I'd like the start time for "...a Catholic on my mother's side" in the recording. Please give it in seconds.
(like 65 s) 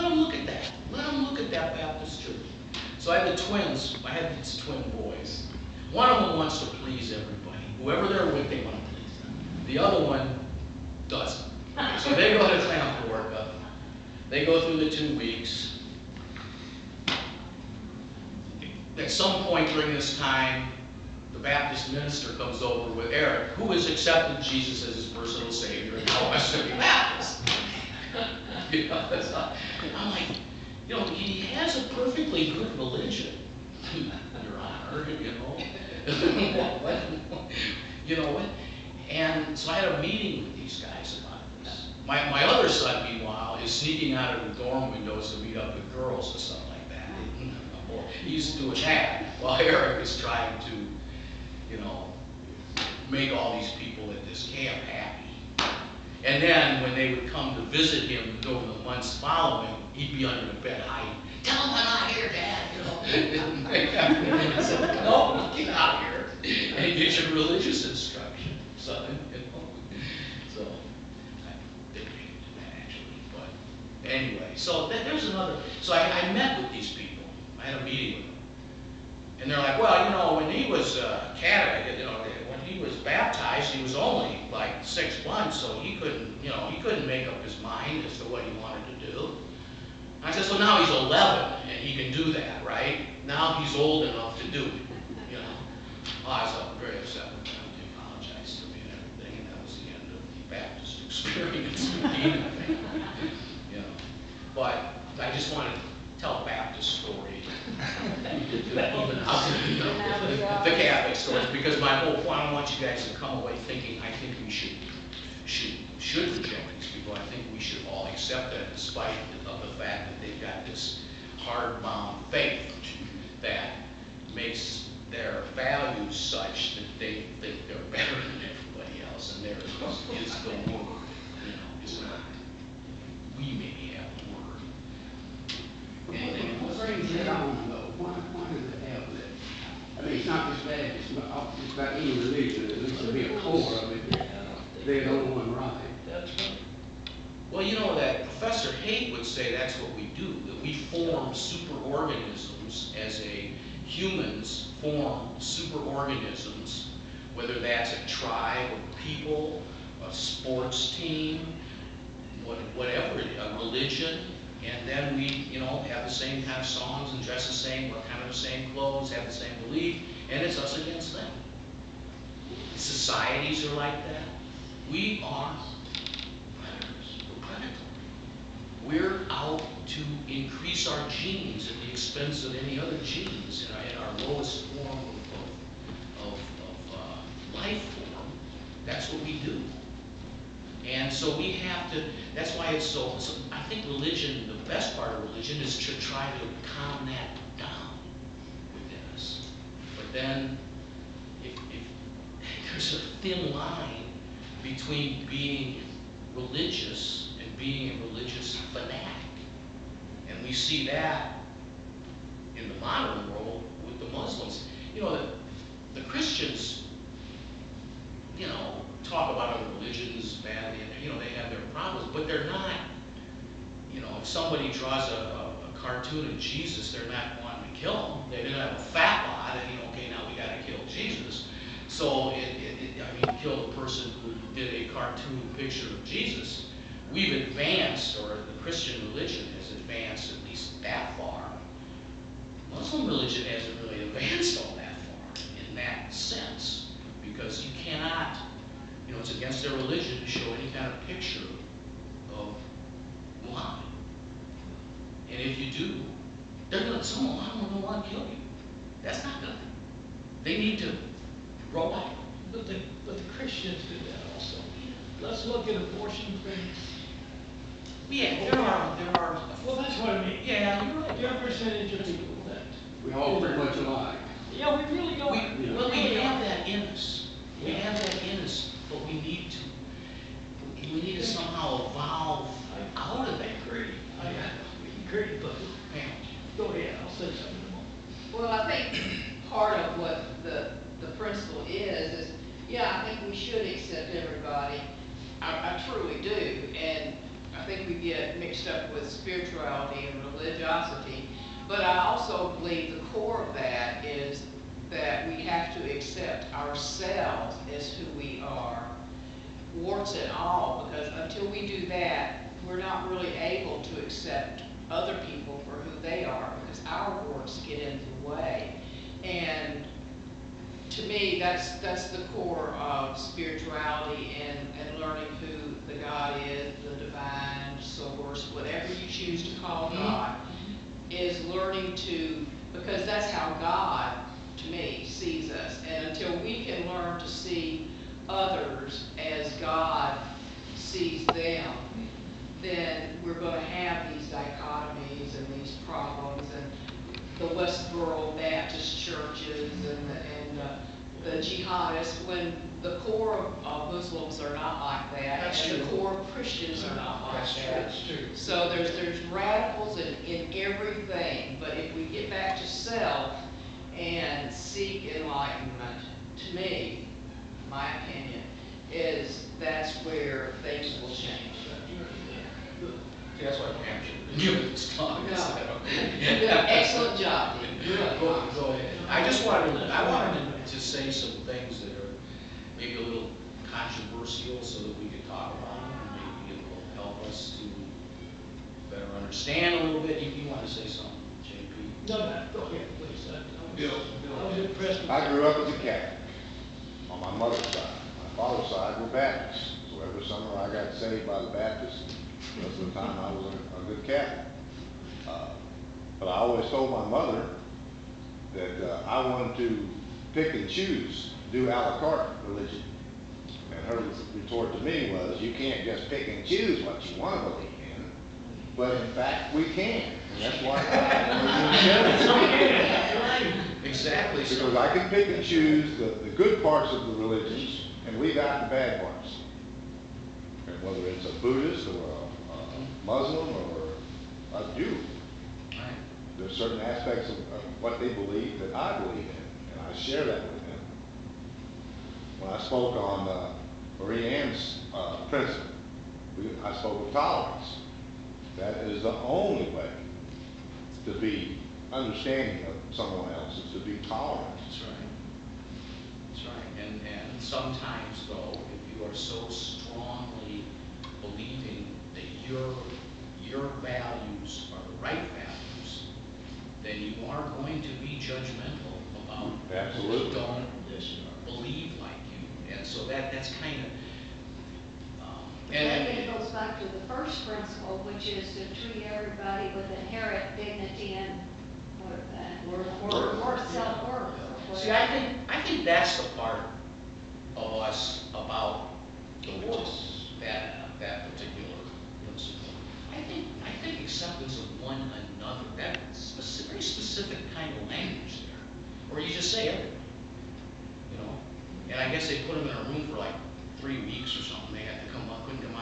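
395 s.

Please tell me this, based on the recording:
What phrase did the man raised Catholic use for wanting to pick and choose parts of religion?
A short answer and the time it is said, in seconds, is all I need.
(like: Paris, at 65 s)
a la carte religion, at 411 s.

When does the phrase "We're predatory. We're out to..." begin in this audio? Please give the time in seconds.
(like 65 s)
177 s.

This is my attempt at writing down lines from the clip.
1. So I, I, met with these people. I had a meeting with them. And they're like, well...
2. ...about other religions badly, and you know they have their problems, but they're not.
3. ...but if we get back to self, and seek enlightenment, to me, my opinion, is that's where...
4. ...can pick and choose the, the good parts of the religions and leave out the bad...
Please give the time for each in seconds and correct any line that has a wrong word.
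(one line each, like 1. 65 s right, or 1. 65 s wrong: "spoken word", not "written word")
1. 75 s right
2. 219 s right
3. 361 s right
4. 424 s right.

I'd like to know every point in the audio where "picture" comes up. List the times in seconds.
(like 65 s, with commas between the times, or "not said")
235 s, 251 s.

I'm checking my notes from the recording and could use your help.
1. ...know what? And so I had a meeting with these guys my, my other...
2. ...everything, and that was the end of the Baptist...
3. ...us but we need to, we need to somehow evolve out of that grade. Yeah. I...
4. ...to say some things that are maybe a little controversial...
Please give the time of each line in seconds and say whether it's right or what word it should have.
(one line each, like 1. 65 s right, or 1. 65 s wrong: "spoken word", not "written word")
1. 38 s right
2. 98 s right
3. 278 s right
4. 380 s right.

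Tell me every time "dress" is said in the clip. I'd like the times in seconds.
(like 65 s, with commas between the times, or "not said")
167 s.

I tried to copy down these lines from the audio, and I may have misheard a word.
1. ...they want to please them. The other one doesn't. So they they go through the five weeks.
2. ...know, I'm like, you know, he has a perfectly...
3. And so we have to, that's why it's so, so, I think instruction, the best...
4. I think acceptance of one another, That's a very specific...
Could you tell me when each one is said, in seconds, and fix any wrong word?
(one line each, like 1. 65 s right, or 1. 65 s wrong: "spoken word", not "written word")
1. 8 s wrong: "two", not "five"
2. 28 s right
3. 190 s wrong: "religion", not "instruction"
4. 493 s right.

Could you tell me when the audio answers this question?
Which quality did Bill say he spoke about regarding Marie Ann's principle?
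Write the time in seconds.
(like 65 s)
447 s.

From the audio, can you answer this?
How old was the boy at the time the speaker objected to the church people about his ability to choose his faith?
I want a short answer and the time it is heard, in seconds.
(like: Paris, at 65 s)
11, at 90 s.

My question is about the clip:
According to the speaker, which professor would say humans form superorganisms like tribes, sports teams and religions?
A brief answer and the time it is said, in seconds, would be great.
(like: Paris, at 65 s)
Professor Haidt, at 148 s.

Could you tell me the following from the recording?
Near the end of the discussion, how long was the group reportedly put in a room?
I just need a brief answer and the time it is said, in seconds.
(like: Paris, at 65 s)
3 weeks, at 503 s.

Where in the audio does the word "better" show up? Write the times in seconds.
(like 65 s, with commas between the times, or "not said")
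127 s, 388 s.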